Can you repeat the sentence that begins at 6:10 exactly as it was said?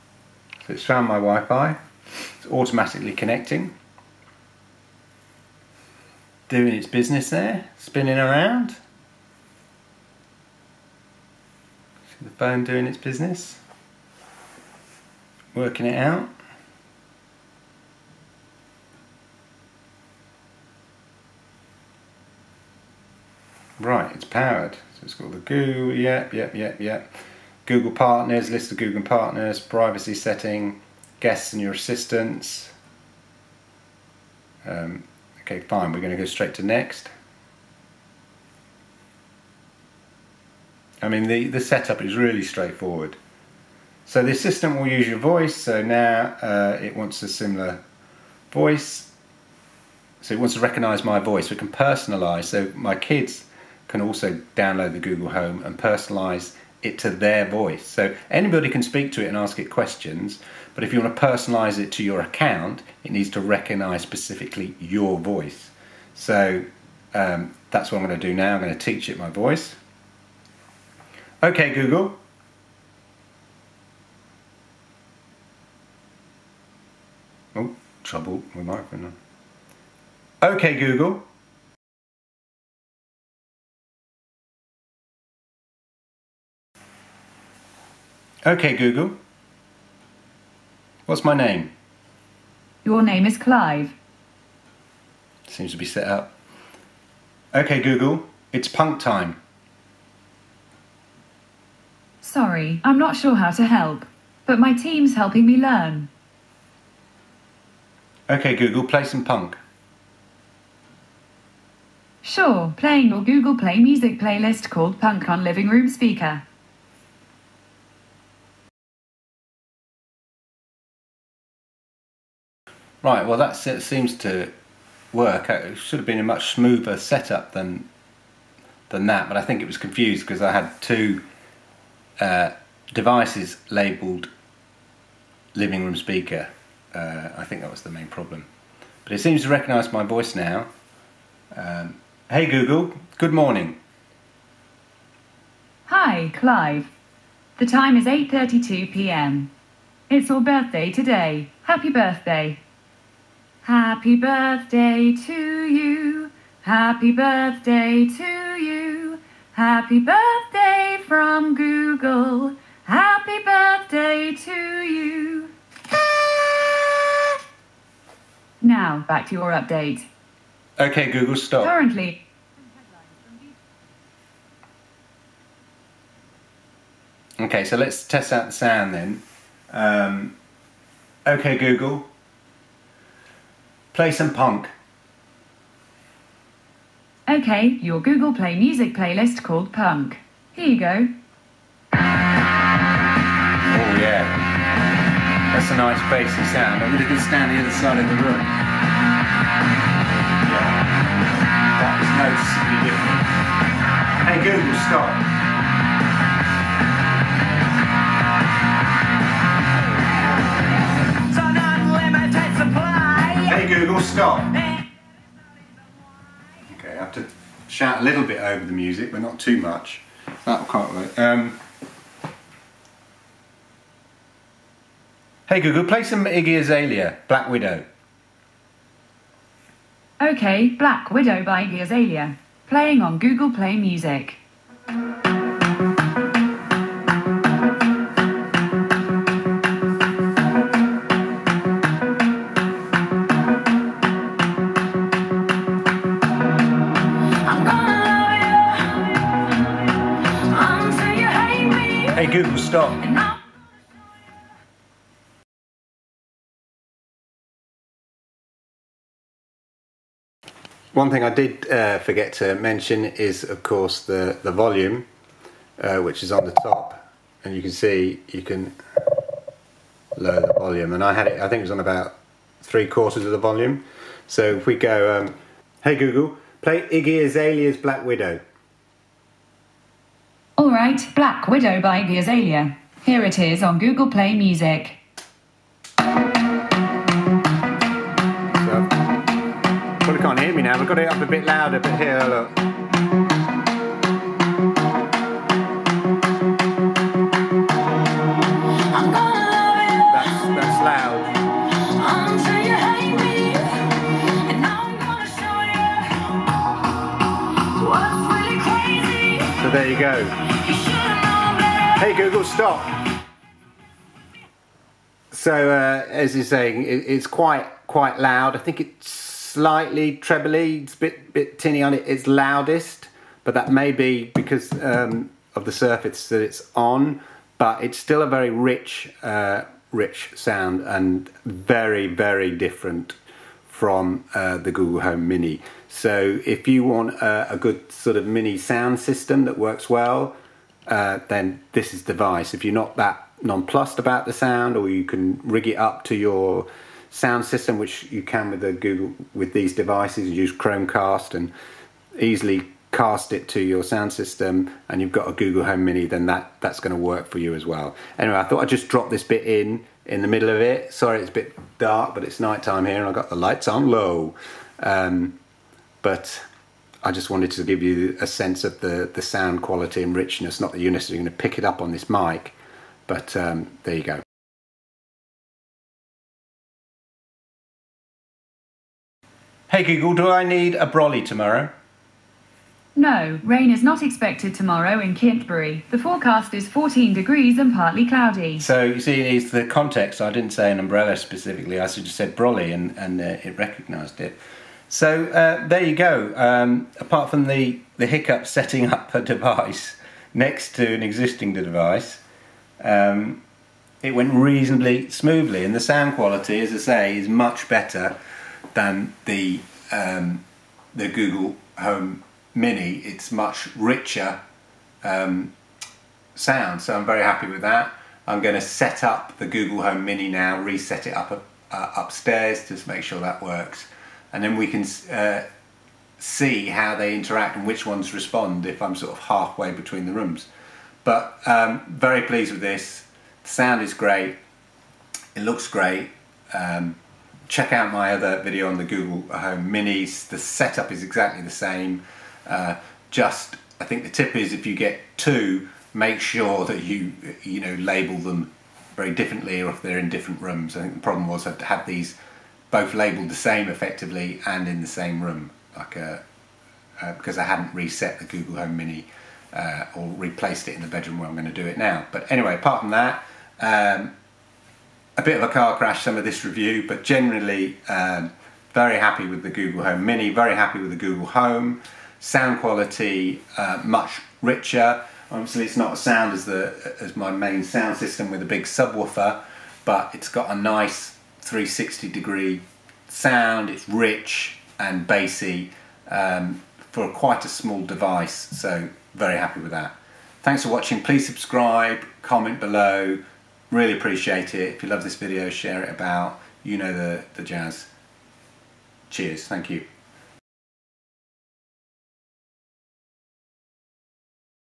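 Not that you're necessarily going to pick it up on this mic, but um, there you go.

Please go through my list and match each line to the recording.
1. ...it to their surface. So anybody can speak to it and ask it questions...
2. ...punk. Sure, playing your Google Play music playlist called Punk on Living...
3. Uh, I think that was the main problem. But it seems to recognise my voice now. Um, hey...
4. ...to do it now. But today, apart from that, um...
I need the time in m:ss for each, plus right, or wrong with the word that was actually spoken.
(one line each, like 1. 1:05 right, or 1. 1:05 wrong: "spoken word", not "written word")
1. 0:56 wrong: "voice", not "surface"
2. 1:49 right
3. 2:16 right
4. 7:41 wrong: "anyway", not "today".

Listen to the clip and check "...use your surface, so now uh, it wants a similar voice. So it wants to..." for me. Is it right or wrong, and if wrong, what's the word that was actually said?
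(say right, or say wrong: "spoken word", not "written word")
wrong: "voice", not "surface".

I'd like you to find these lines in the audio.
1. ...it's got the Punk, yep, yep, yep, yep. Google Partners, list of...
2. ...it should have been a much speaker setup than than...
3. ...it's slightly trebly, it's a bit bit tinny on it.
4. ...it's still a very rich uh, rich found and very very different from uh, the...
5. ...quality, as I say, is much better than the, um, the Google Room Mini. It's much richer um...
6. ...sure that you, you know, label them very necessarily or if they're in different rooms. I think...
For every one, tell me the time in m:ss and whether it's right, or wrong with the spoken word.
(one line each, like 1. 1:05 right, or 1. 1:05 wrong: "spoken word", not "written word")
1. 0:25 wrong: "Google", not "Punk"
2. 2:05 wrong: "smoother", not "speaker"
3. 5:18 right
4. 5:27 wrong: "sound", not "found"
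5. 6:46 wrong: "Home", not "Room"
6. 7:26 wrong: "differently", not "necessarily".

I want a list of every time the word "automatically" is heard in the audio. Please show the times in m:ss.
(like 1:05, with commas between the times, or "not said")
0:02.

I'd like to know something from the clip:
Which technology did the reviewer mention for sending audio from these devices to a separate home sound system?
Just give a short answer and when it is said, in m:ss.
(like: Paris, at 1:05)
Chromecast, at 5:50.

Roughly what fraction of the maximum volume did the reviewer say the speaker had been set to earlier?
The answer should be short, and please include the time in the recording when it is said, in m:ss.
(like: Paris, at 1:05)
Three quarters, at 4:32.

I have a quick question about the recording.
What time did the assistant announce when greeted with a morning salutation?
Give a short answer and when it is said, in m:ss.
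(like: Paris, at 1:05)
8:32 p.m., at 2:28.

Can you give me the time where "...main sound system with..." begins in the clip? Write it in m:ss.
7:57.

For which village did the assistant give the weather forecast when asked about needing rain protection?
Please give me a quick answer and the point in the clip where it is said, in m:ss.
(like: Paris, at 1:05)
Kintbury, at 6:25.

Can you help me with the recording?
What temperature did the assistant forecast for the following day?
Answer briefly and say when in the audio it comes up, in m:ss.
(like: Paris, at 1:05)
14 degrees, at 6:26.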